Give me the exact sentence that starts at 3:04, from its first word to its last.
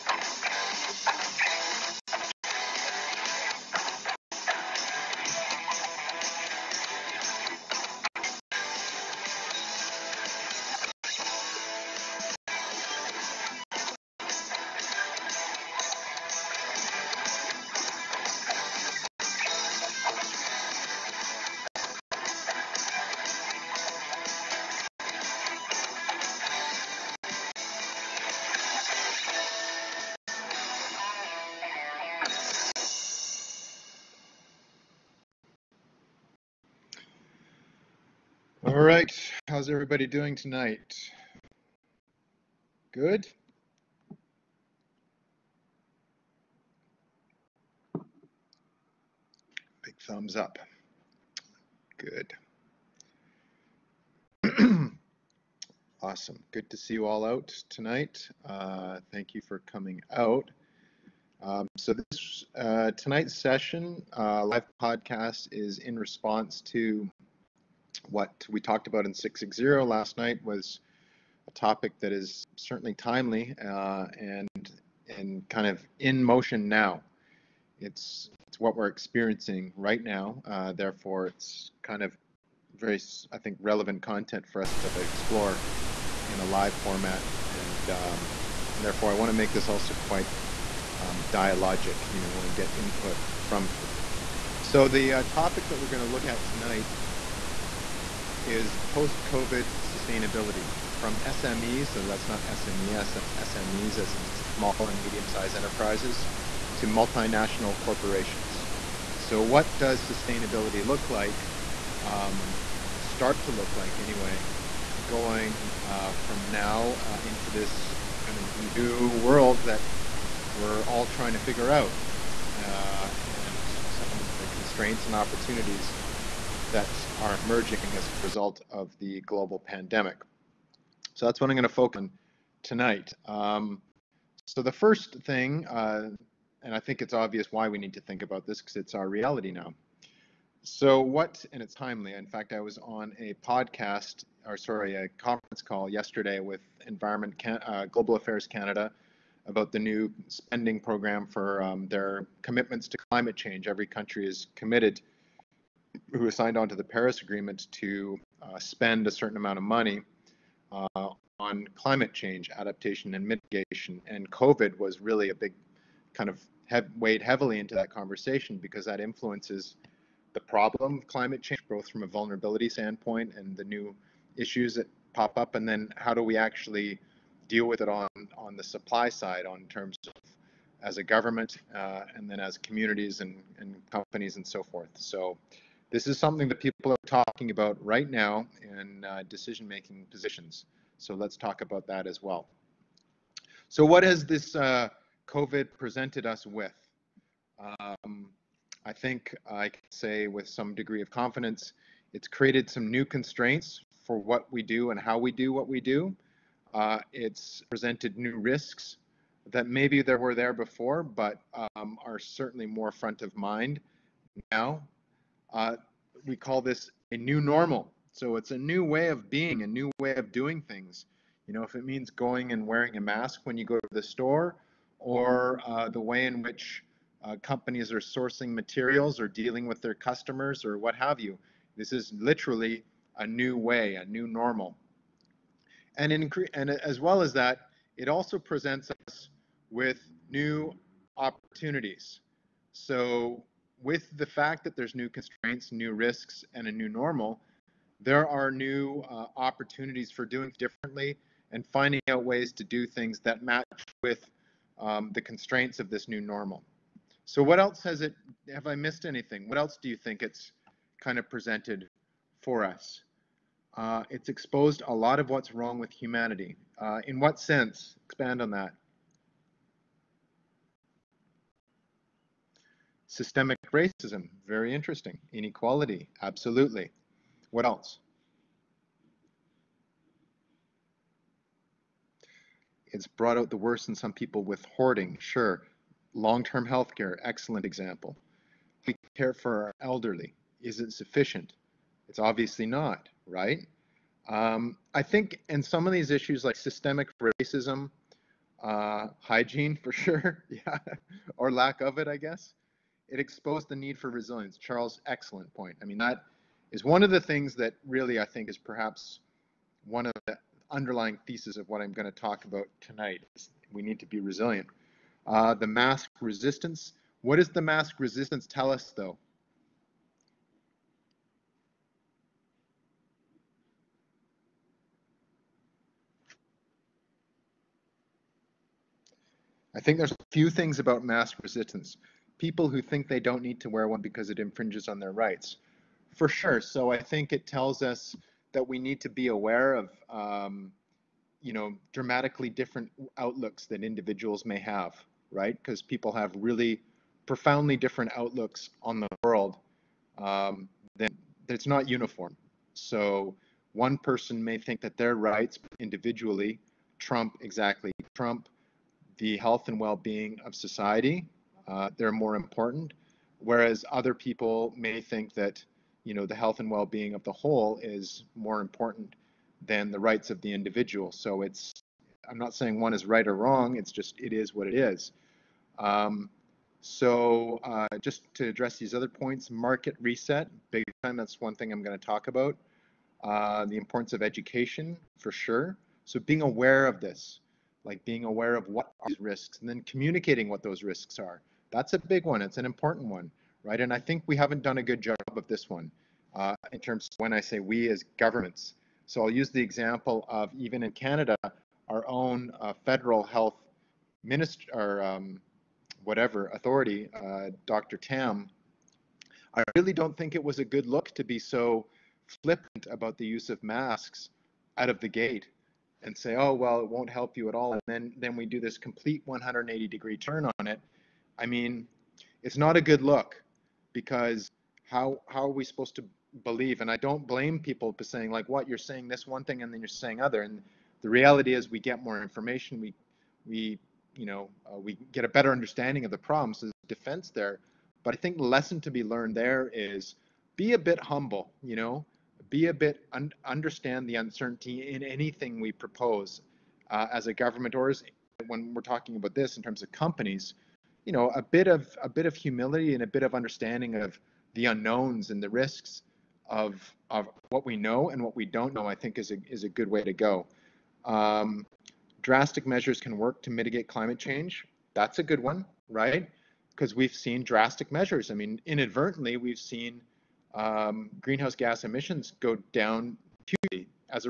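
So this is something that people are talking about right now in uh, decision-making positions.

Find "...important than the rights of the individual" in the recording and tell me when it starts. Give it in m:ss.
6:08.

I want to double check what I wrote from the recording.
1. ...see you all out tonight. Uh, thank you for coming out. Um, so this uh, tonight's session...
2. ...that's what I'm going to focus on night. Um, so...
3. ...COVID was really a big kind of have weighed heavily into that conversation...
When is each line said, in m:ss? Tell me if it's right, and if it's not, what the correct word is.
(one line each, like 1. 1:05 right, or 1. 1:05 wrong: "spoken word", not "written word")
1. 0:56 right
2. 2:11 wrong: "tonight", not "night"
3. 2:44 right.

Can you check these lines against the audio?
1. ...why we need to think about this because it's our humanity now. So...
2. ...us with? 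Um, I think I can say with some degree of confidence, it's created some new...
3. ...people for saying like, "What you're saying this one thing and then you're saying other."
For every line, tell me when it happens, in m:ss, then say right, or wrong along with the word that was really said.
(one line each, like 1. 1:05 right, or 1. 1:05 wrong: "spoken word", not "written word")
1. 2:17 wrong: "reality", not "humanity"
2. 3:16 right
3. 7:07 right.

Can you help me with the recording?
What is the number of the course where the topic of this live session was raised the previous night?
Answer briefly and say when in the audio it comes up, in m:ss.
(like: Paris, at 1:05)
660, at 1:09.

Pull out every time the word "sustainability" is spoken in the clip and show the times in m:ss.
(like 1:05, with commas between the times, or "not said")
1:39, 1:50.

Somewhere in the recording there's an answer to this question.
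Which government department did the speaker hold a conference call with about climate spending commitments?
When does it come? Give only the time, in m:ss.
2:27.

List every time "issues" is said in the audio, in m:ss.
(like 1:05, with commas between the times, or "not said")
2:54, 4:56.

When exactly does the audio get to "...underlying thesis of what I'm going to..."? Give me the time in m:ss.
5:10.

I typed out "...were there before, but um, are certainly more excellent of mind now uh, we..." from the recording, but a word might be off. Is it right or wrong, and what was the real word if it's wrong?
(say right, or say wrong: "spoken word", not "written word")
wrong: "front", not "excellent".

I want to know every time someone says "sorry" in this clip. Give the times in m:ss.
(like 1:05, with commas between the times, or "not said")
2:24.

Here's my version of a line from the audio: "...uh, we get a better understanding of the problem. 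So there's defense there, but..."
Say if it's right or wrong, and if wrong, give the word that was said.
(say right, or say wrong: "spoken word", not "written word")
right.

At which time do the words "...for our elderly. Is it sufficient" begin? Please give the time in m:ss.
4:49.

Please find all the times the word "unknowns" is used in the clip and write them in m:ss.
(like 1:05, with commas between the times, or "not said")
7:34.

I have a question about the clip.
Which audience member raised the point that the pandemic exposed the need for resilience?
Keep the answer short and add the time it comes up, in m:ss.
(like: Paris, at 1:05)
Charles, at 5:04.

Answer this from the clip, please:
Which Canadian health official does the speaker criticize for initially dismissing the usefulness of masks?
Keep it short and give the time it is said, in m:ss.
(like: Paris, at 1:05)
Dr. Tam, at 6:47.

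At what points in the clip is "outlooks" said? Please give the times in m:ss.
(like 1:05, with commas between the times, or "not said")
5:43, 5:48.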